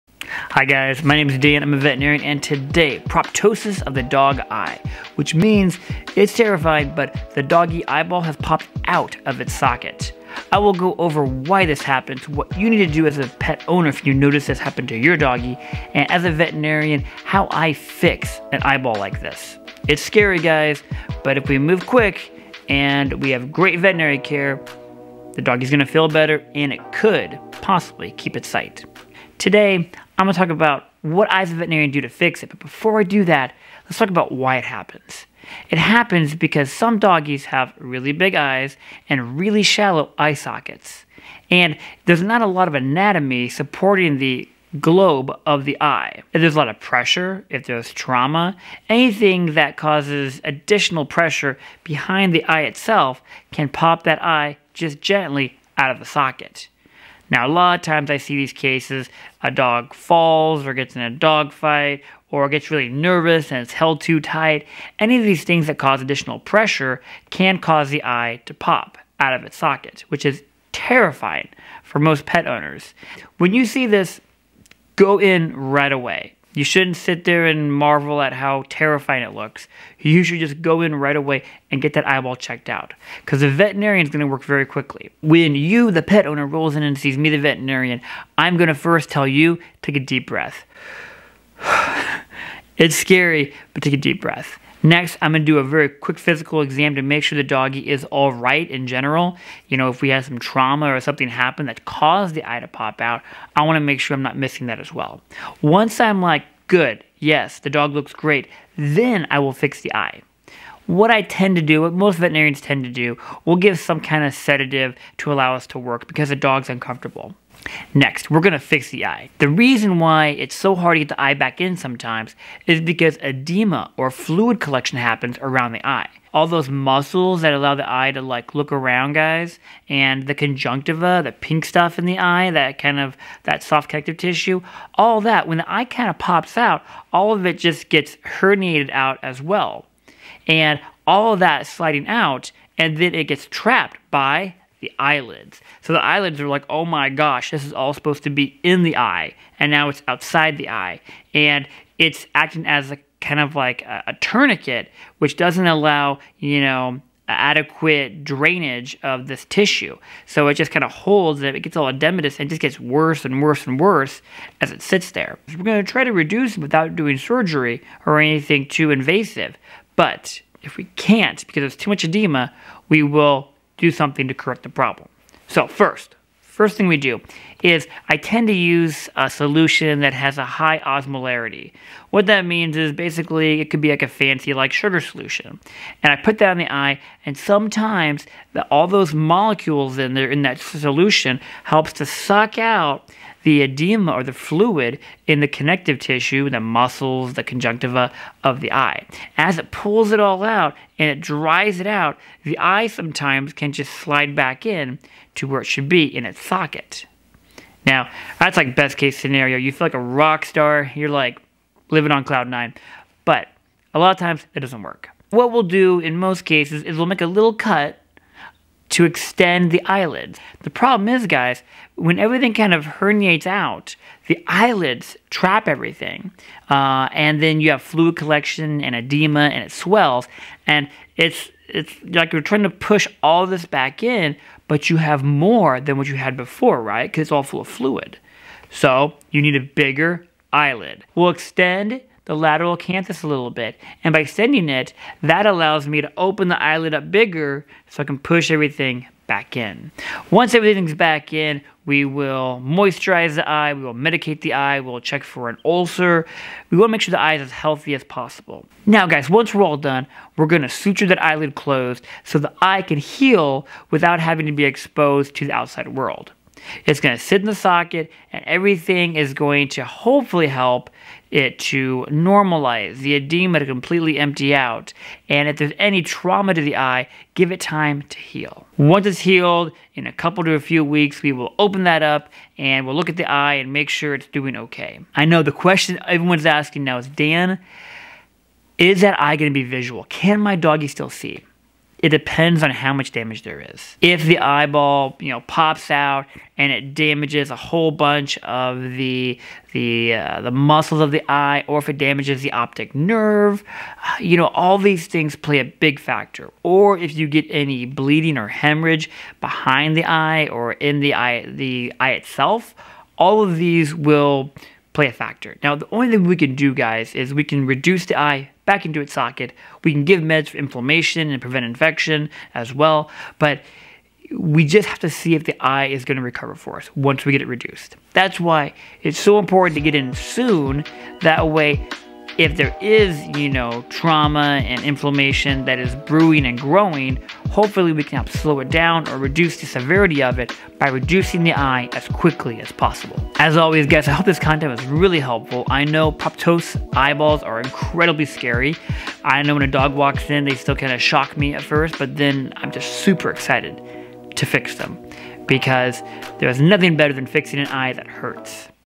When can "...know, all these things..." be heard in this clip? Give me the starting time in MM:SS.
05:04.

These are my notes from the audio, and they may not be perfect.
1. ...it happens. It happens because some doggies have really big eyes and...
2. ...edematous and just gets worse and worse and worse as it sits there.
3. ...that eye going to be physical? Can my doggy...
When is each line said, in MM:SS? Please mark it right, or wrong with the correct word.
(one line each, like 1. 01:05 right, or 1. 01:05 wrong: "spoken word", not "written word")
1. 00:34 right
2. 02:41 right
3. 04:49 wrong: "visual", not "physical".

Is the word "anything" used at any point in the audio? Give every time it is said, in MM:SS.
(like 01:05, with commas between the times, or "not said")
00:48, 02:48.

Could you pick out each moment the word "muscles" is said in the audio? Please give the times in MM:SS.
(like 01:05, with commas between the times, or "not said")
02:06, 03:16, 05:00.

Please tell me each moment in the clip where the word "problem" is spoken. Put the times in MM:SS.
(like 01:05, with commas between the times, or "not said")
02:54, 03:40.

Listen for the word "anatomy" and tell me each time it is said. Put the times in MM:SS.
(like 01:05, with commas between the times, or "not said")
00:42.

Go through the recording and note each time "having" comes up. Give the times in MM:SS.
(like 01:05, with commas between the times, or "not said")
04:24.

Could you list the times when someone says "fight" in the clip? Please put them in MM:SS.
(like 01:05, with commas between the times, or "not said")
01:01.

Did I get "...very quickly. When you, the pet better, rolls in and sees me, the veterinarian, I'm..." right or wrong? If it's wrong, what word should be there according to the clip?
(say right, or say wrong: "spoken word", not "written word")
wrong: "owner", not "better".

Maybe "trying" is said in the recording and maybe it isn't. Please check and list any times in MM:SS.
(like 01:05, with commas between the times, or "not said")
03:52.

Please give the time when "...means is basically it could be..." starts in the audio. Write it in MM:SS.
03:02.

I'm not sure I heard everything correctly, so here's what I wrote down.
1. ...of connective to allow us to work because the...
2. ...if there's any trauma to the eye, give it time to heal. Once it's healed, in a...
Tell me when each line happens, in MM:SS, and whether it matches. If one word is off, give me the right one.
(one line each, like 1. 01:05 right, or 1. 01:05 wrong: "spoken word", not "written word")
1. 01:54 wrong: "sedative", not "connective"
2. 04:35 right.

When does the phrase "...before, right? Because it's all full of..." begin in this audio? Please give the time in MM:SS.
03:56.